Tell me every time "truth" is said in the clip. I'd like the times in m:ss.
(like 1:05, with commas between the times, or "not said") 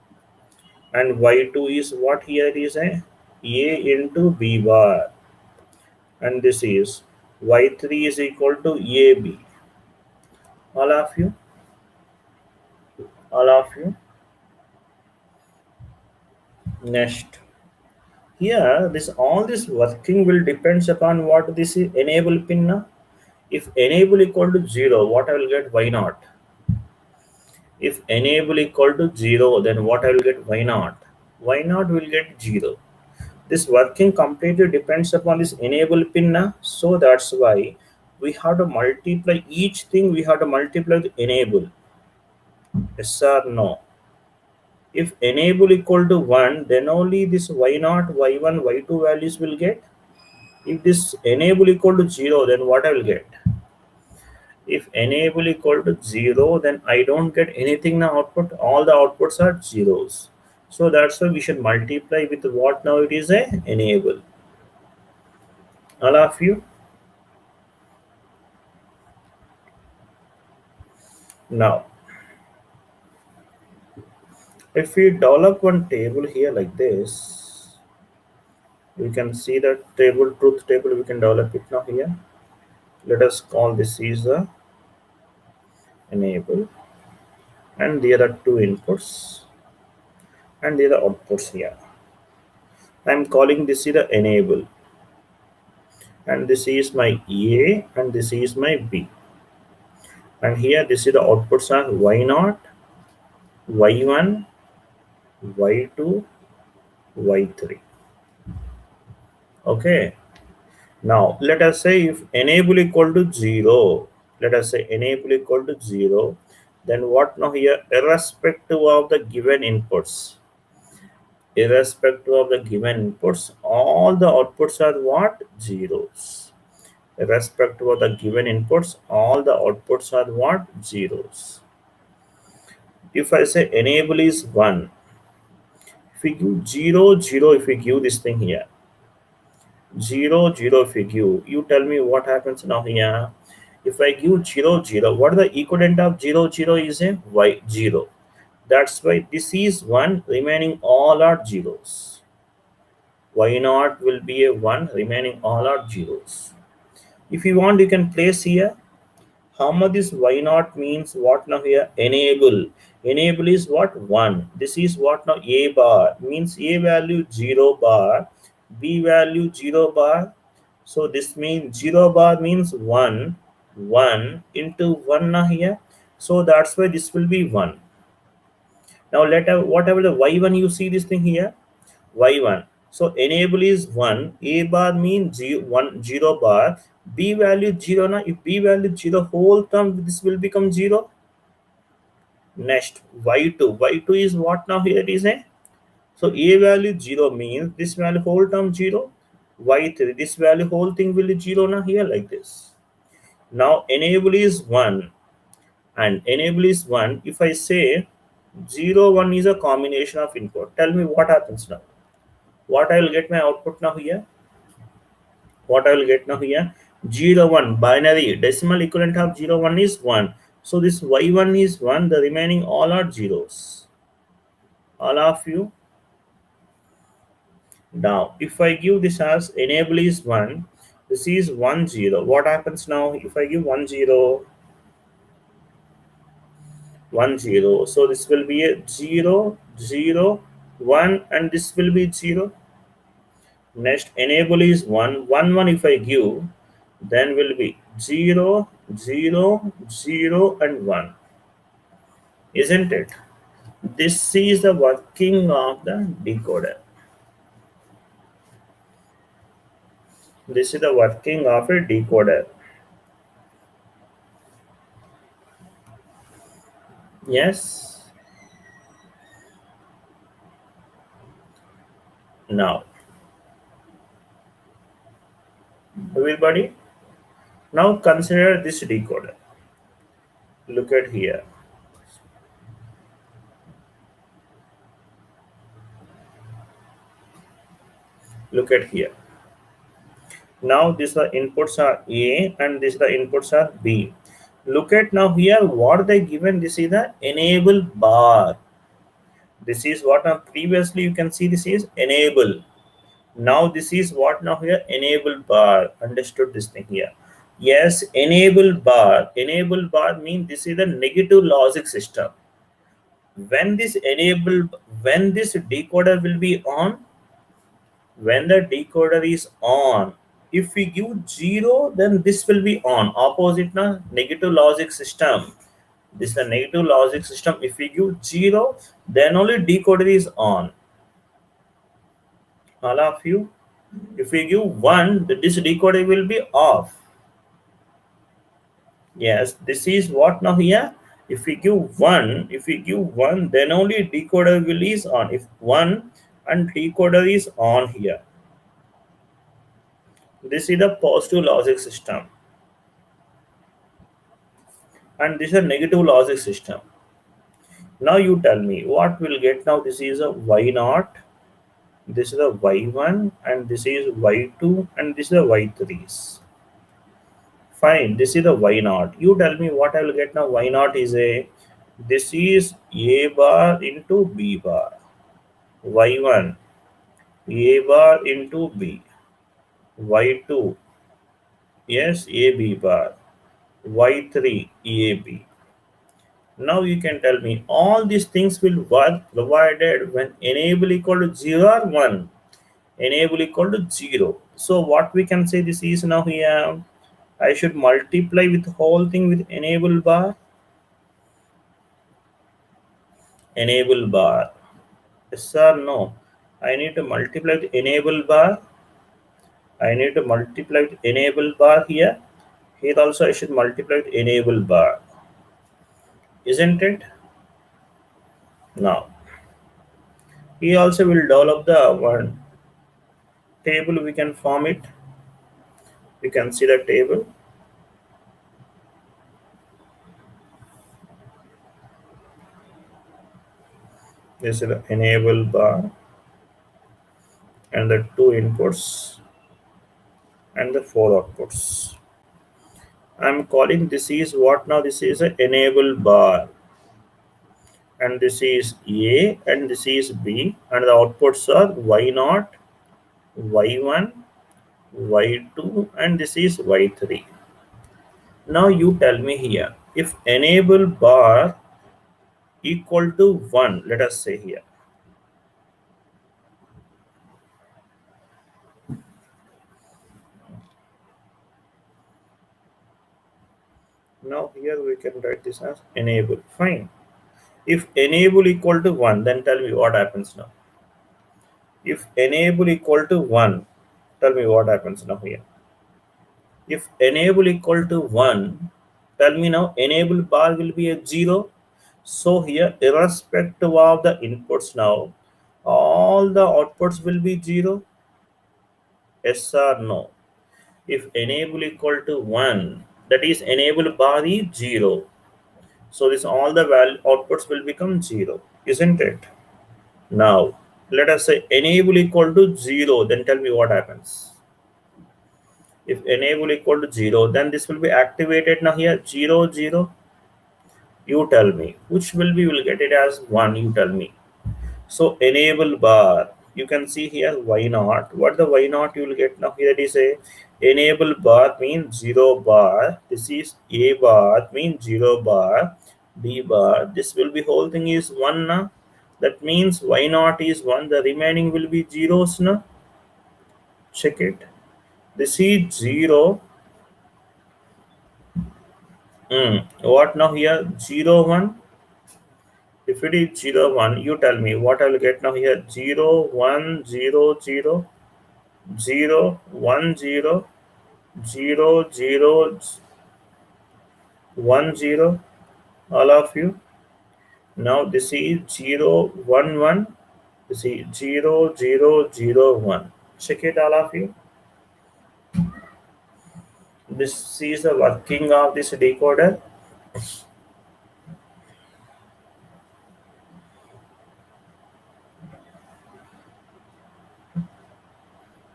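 1:20.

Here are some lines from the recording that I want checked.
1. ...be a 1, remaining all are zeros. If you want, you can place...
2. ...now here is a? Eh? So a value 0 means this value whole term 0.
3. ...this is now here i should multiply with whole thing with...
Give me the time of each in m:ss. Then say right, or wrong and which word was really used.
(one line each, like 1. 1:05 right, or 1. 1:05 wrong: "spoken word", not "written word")
1. 2:34 right
2. 3:14 right
3. 6:35 right.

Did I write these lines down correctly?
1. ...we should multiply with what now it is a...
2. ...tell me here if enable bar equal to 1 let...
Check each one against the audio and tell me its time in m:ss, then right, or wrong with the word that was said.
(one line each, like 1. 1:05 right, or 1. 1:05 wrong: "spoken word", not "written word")
1. 1:01 right
2. 7:38 right.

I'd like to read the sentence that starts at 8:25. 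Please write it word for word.
So this all the value outputs will become zero, isn't it?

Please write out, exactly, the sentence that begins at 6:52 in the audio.
Here also I should multiply with enable bar.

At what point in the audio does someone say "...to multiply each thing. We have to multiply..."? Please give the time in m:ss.
0:38.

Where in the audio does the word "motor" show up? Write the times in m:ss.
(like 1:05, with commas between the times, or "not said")
not said.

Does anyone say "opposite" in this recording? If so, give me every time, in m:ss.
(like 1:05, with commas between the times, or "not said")
5:23.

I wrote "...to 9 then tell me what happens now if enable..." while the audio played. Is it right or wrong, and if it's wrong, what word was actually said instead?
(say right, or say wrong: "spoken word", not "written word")
wrong: "1", not "9".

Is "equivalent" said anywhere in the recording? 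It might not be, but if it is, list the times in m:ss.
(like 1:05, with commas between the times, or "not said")
2:25, 3:38.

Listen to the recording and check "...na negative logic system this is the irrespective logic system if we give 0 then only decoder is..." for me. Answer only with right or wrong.
wrong.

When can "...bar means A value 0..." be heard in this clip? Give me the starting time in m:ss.
2:45.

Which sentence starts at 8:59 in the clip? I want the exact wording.
that means y naught is 1 the remaining will be zeros na?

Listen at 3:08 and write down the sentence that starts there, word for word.
Now if b value 0 whole term, this will become 0.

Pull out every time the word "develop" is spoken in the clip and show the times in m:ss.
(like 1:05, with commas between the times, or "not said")
1:15, 1:21, 7:01.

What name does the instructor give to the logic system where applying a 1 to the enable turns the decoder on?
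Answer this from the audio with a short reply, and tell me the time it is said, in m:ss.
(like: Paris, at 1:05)
positive logic system, at 5:50.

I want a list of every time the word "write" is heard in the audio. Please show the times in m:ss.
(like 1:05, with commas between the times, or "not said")
7:55.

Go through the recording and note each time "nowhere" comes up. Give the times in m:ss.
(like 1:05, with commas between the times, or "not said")
not said.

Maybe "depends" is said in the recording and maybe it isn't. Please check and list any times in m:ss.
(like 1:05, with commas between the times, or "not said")
0:20, 0:34.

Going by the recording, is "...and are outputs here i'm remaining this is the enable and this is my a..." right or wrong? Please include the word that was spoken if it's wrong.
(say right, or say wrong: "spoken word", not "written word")
wrong: "calling", not "remaining".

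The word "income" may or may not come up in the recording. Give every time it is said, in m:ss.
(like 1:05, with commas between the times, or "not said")
not said.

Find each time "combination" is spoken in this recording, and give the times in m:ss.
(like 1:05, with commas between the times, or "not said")
3:29.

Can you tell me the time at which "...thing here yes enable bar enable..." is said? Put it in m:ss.
5:06.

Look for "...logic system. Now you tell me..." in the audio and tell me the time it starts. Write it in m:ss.
5:55.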